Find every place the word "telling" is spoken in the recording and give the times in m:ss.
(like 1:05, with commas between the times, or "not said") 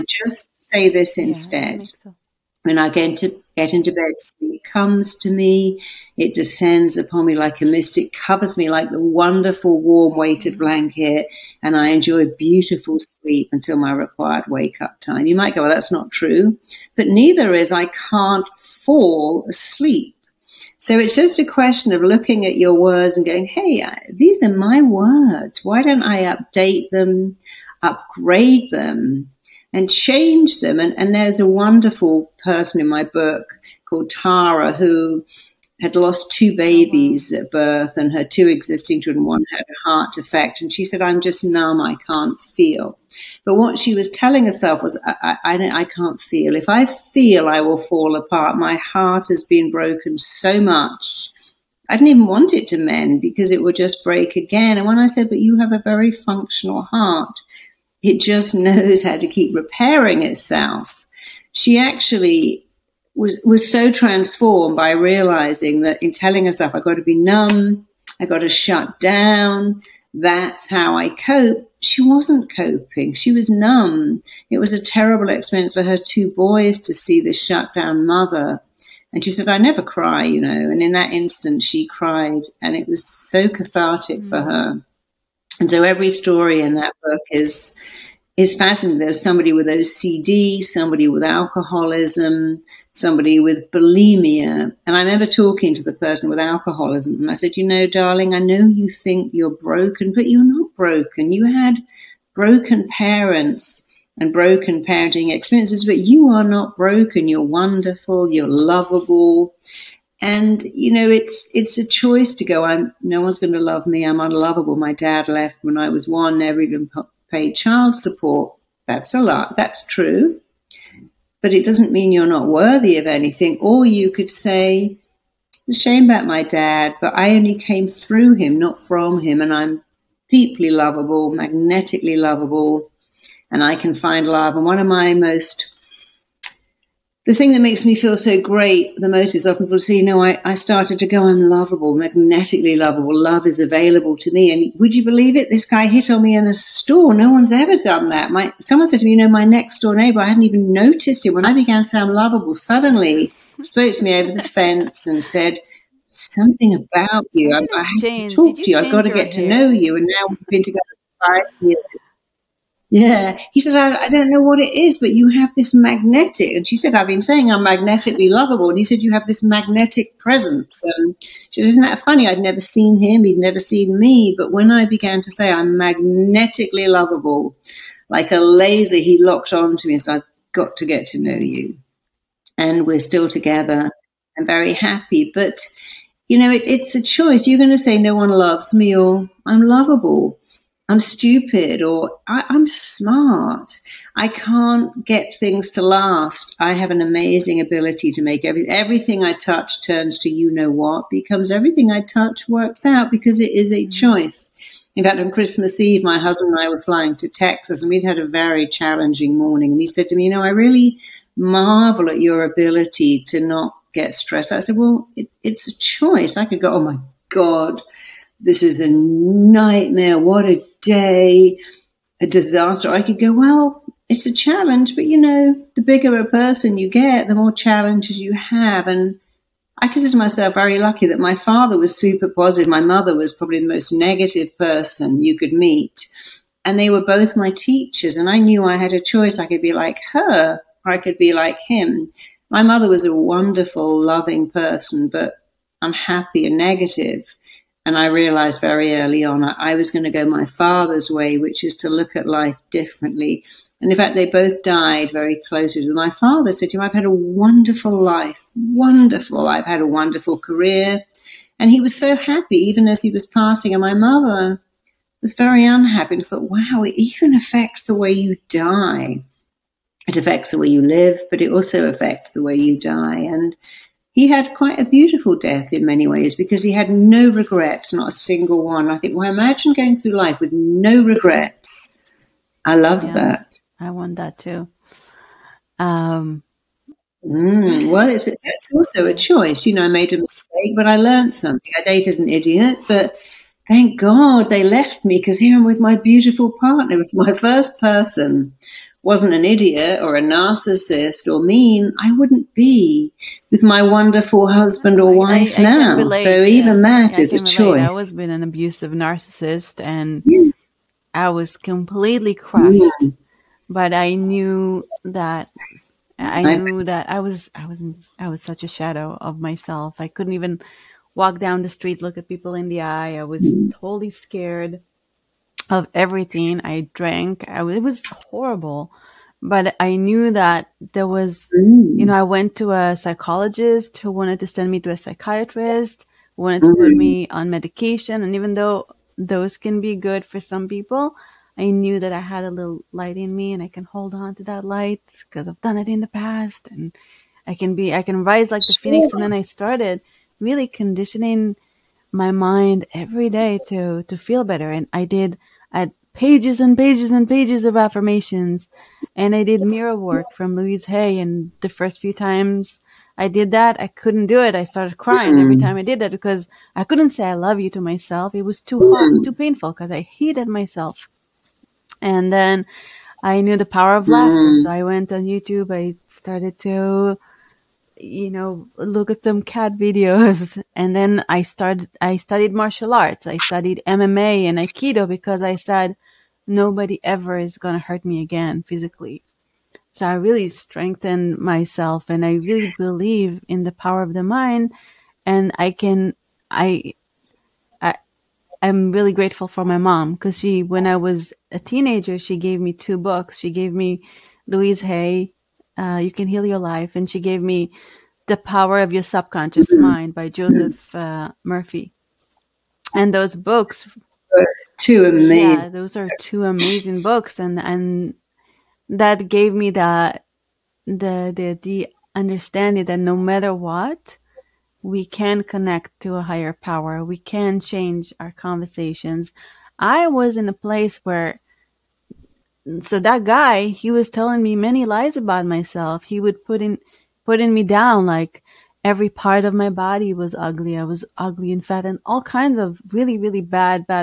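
0:44, 1:06, 7:14.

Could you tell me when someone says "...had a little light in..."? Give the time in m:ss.
5:42.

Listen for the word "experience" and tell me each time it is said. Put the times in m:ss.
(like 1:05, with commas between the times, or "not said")
1:15, 1:45.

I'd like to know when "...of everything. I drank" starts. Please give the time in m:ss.
5:25.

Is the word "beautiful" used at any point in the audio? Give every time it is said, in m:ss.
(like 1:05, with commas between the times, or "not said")
0:12, 4:34, 4:55.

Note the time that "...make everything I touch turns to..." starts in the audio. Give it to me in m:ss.
3:18.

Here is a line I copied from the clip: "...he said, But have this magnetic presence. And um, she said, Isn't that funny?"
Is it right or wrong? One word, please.
wrong.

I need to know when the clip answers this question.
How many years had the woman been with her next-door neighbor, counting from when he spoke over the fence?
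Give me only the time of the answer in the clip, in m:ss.
2:41.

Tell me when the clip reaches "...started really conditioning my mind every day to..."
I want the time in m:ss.
5:49.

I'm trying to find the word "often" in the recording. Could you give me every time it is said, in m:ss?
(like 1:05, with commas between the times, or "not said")
2:19.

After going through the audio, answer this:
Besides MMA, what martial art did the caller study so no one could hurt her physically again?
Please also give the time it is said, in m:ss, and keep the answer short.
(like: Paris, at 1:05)
aikido, at 6:24.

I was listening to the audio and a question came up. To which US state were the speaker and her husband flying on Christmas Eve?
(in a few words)
Texas.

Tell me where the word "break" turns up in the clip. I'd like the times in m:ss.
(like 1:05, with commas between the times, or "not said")
0:54.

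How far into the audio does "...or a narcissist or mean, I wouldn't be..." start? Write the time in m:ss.
5:00.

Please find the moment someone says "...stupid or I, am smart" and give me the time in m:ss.
3:10.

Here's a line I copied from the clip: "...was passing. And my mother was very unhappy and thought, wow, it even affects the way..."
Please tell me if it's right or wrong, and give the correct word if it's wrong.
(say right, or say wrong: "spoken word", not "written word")
right.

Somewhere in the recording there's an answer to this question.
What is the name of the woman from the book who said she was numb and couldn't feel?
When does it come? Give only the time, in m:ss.
0:34.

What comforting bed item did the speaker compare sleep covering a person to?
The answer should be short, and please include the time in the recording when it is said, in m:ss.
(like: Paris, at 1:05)
warm weighted blanket, at 0:09.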